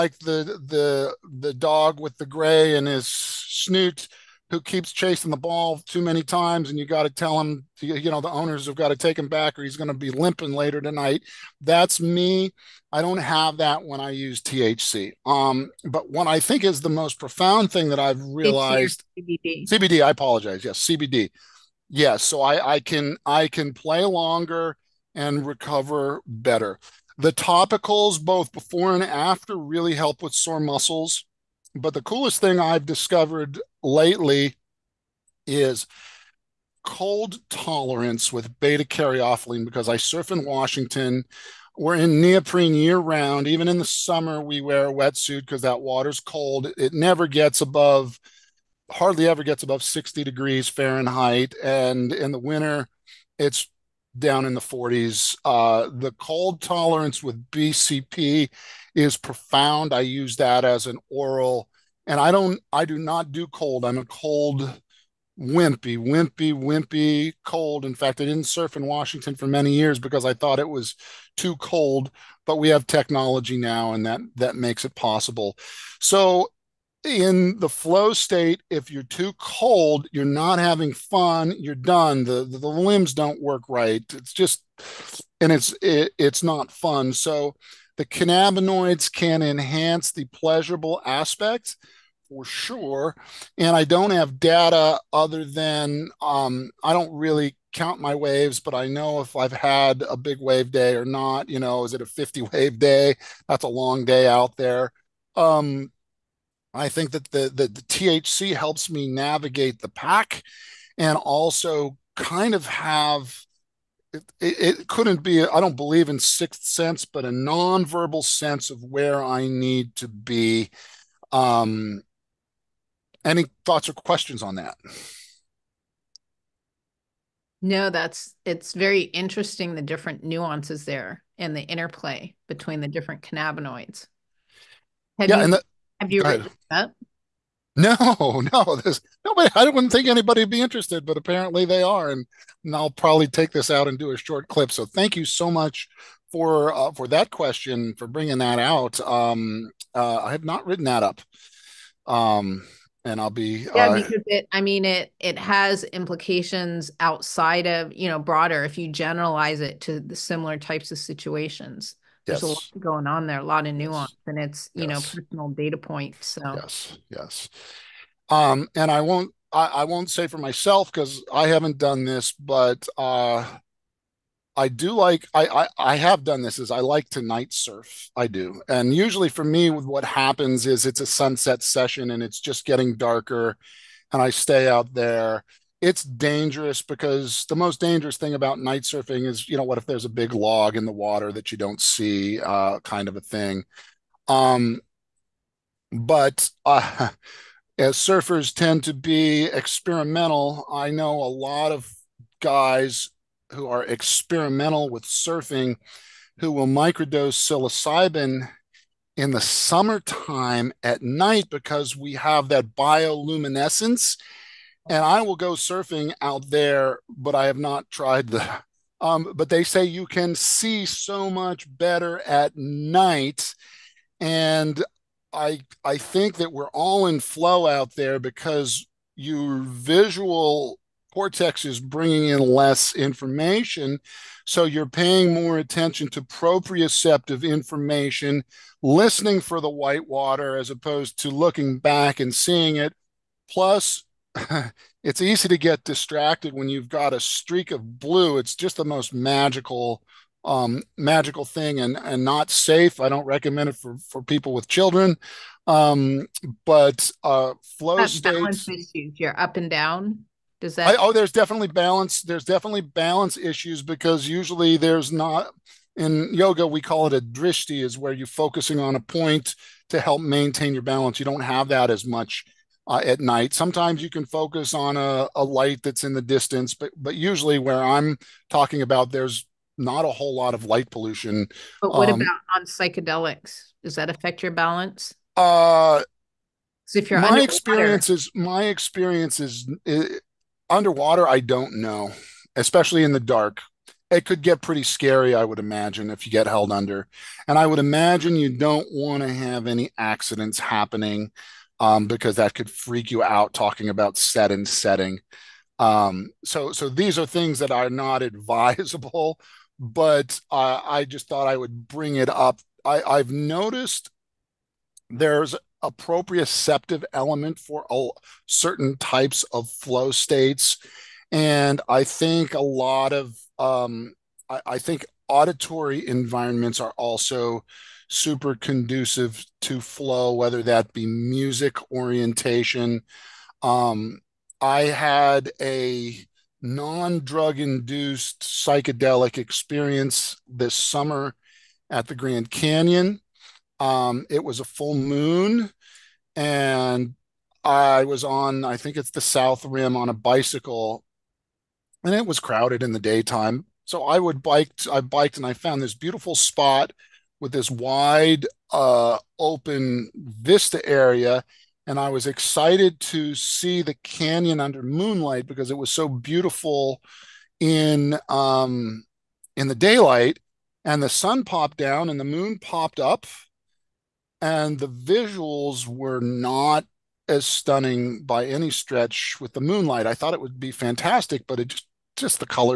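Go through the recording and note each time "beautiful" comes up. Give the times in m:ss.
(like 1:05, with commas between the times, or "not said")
5:55, 6:06.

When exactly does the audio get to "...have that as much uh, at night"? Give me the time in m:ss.
4:31.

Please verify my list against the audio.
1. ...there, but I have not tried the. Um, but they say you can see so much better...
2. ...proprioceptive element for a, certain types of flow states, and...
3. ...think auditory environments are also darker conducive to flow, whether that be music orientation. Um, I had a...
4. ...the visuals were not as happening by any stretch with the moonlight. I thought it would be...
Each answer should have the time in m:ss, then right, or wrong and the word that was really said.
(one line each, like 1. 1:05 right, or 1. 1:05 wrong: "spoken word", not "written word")
1. 3:36 right
2. 5:15 right
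3. 5:24 wrong: "super", not "darker"
4. 6:14 wrong: "stunning", not "happening".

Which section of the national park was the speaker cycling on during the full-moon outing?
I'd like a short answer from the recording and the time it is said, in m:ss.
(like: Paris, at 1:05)
South Rim, at 5:49.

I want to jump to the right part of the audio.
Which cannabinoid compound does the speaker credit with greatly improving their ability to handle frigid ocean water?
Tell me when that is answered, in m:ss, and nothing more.
0:38.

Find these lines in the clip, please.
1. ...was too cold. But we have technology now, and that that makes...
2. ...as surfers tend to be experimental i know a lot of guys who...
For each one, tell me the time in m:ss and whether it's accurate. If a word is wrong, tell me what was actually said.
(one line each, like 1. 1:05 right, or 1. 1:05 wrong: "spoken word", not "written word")
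1. 1:10 right
2. 3:17 right.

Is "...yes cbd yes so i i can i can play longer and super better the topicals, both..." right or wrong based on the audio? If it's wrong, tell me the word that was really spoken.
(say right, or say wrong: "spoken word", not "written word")
wrong: "recover", not "super".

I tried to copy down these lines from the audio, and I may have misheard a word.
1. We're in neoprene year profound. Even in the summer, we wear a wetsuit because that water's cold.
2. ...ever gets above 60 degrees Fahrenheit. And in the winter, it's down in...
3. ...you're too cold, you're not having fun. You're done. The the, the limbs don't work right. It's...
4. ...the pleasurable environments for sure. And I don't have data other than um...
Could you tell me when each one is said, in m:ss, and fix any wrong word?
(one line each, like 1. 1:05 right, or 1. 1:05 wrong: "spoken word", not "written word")
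1. 0:41 wrong: "round", not "profound"
2. 0:49 right
3. 1:18 right
4. 1:30 wrong: "aspects", not "environments".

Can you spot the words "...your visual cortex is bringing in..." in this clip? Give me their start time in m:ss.
3:49.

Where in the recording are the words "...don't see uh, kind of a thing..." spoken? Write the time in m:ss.
3:11.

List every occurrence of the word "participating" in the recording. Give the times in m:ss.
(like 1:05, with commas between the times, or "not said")
not said.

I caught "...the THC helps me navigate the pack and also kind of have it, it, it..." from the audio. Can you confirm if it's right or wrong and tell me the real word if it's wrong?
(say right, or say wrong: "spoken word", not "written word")
right.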